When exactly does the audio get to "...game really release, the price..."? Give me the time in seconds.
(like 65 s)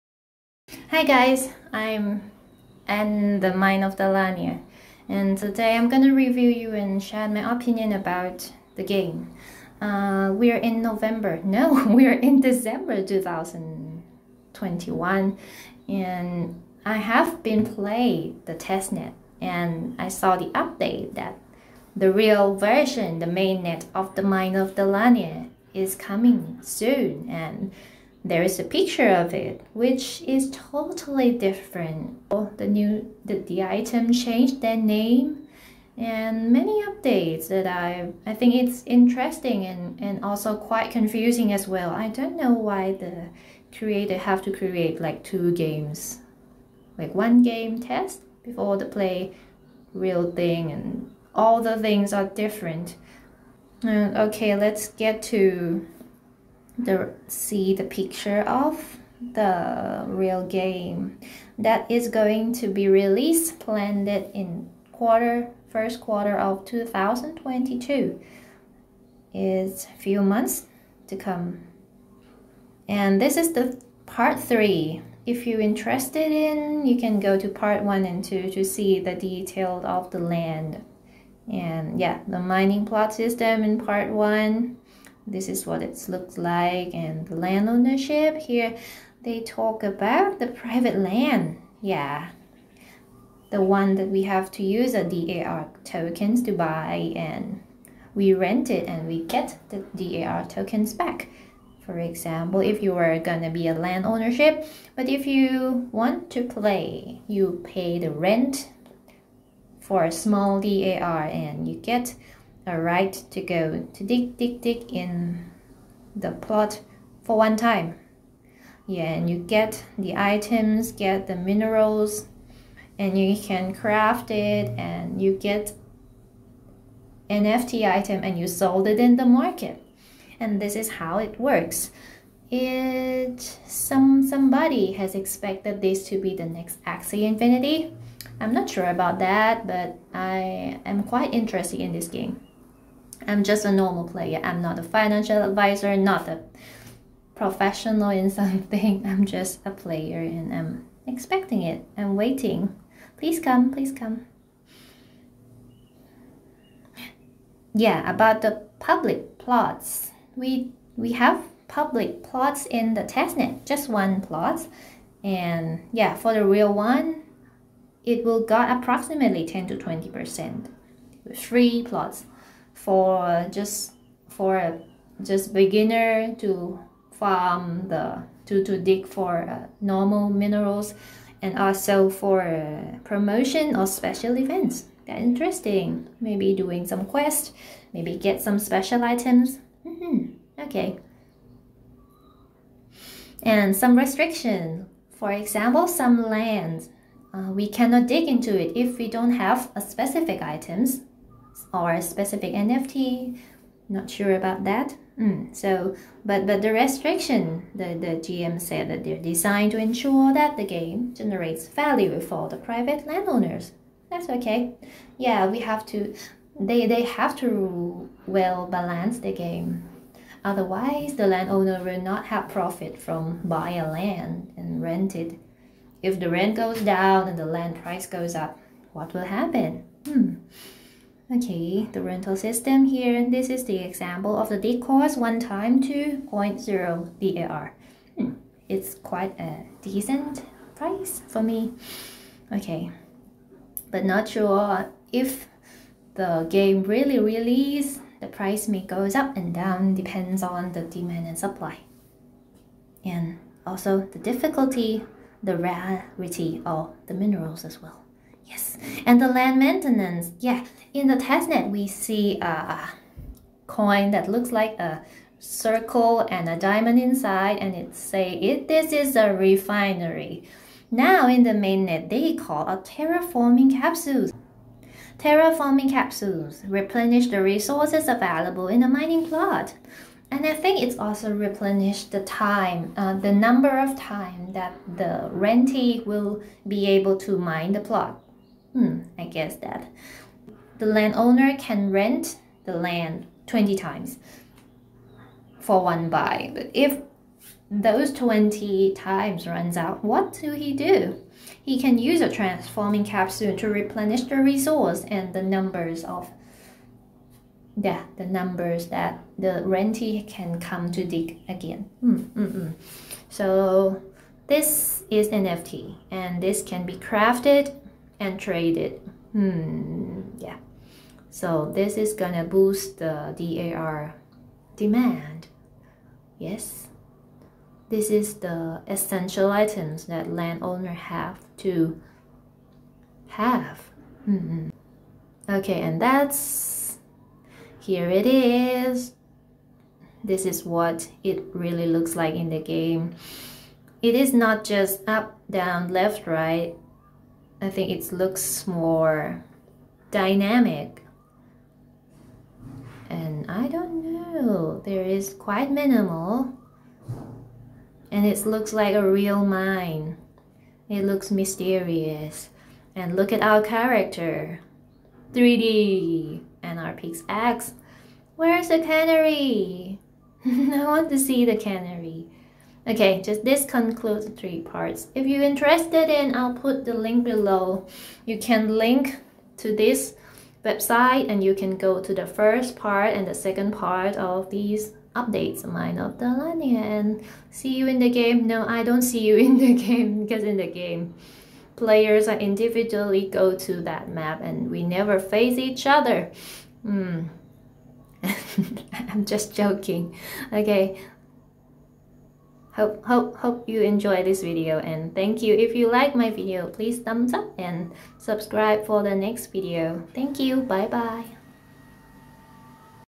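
246 s.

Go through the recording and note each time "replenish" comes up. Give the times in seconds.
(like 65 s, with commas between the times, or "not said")
276 s, 281 s, 303 s.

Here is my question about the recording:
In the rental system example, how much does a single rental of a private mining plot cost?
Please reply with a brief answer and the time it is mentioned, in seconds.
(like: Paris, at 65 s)
2.0 DAR, at 235 s.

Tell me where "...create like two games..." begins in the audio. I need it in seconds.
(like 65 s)
44 s.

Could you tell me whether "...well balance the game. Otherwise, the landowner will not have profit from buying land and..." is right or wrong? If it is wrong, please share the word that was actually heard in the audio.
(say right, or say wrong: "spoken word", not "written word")
right.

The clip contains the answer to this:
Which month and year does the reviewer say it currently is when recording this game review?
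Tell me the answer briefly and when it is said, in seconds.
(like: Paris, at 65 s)
December 2021, at 12 s.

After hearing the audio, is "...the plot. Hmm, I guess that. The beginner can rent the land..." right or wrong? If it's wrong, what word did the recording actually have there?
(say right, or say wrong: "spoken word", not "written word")
wrong: "landowner", not "beginner".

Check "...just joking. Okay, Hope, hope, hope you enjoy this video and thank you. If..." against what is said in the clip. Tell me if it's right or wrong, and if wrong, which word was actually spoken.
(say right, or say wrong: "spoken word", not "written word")
right.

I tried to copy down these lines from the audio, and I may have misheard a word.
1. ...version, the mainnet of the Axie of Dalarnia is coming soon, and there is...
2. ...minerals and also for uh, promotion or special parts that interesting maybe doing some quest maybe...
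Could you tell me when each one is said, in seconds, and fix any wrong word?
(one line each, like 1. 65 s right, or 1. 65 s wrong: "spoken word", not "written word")
1. 22 s wrong: "Mines", not "Axie"
2. 180 s wrong: "events", not "parts".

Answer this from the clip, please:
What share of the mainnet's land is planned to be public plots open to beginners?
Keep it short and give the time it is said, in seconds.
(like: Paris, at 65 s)
10 to 20%, at 169 s.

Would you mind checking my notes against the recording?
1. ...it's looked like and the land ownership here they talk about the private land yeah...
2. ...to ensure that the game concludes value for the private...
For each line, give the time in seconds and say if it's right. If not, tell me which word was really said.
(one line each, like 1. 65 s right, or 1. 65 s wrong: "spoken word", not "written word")
1. 85 s right
2. 209 s wrong: "generates", not "concludes".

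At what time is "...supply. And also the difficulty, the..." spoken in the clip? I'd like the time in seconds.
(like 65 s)
251 s.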